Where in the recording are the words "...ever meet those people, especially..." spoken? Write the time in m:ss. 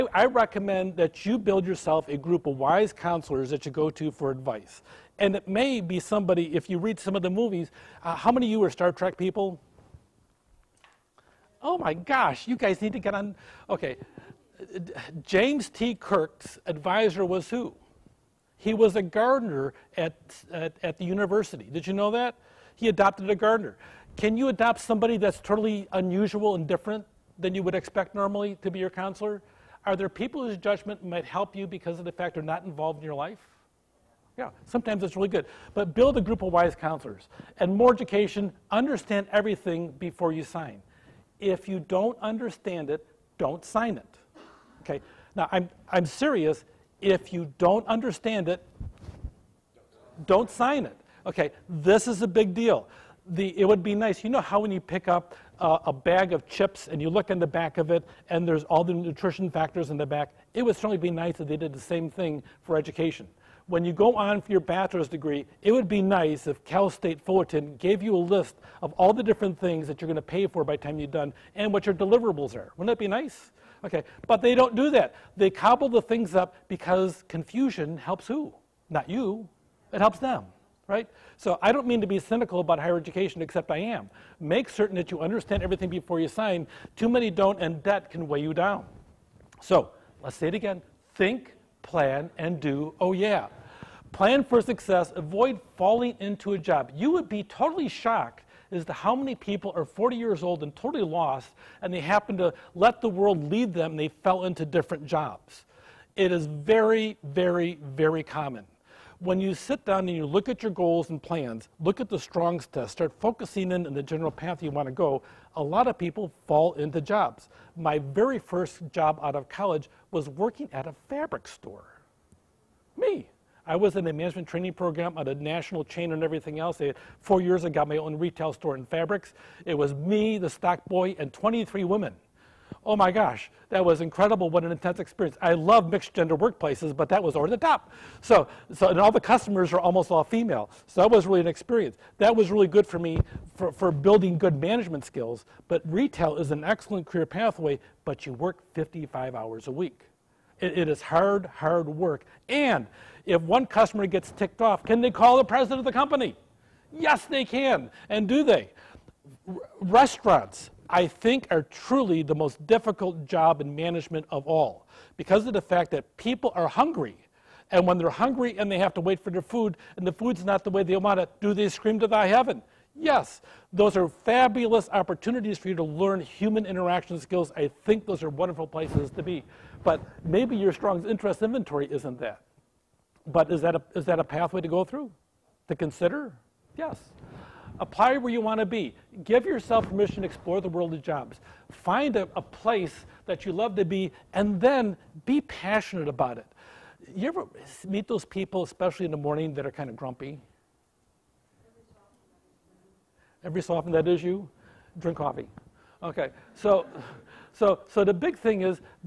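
3:17.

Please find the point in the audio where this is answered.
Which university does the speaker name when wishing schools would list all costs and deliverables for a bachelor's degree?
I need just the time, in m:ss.
1:06.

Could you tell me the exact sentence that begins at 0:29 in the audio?
Are there people whose judgment might help you because of the fact they're not involved in your life?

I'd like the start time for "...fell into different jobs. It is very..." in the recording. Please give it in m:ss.
1:44.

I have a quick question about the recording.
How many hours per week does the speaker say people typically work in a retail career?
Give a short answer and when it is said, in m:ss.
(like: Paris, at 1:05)
55, at 2:28.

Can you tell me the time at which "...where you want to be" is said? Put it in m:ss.
3:08.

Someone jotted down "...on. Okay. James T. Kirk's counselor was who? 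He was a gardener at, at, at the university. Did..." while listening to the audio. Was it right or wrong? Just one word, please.
wrong.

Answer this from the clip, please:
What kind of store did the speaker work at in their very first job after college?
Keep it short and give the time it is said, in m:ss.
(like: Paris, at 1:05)
Fabric store, at 2:01.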